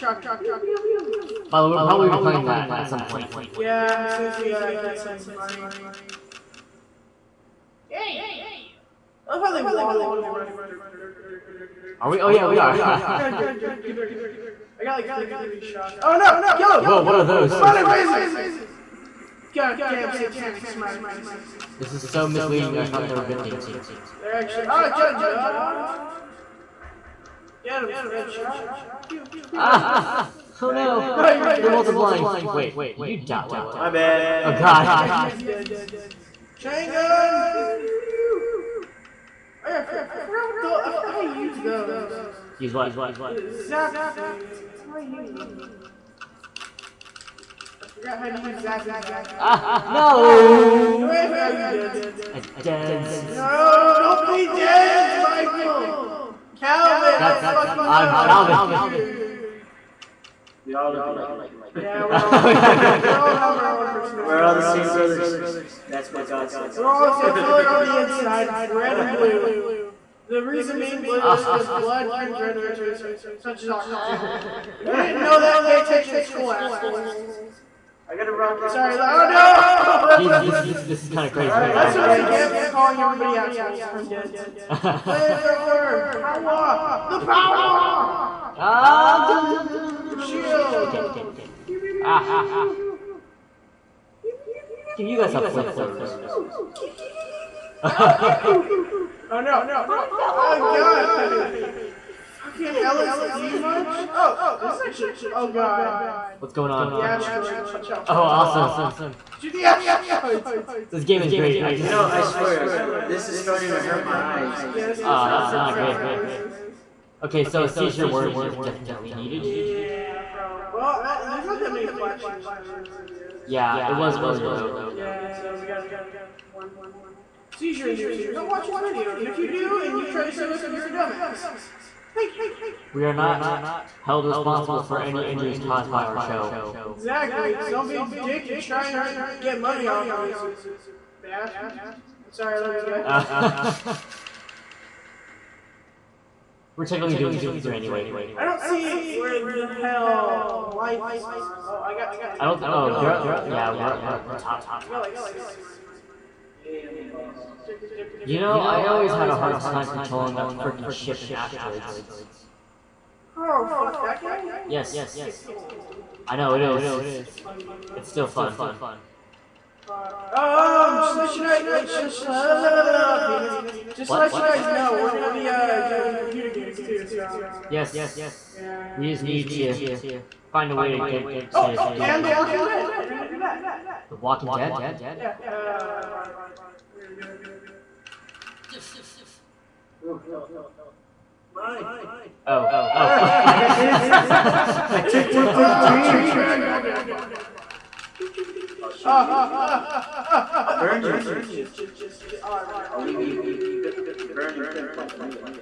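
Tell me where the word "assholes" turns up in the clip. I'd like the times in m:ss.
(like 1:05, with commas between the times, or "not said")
1:16, 1:23.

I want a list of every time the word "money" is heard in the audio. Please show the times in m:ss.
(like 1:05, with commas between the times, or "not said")
0:05, 2:19.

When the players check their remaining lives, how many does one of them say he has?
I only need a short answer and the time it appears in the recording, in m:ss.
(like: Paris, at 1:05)
10, at 2:32.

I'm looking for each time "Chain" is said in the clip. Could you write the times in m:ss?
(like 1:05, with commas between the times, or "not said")
0:36.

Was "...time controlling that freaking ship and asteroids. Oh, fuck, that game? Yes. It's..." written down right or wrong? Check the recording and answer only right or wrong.
right.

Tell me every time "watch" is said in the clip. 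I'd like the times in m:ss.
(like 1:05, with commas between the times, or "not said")
1:47, 2:08.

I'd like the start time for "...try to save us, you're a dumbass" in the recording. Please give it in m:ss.
2:10.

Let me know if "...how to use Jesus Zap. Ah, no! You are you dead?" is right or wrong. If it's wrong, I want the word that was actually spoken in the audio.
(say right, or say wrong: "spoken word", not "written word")
wrong: "Zappy", not "Jesus".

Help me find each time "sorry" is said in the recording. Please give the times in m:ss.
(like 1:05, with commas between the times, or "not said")
1:18, 2:22.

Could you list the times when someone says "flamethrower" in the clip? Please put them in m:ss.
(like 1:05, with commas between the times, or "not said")
1:24, 1:35.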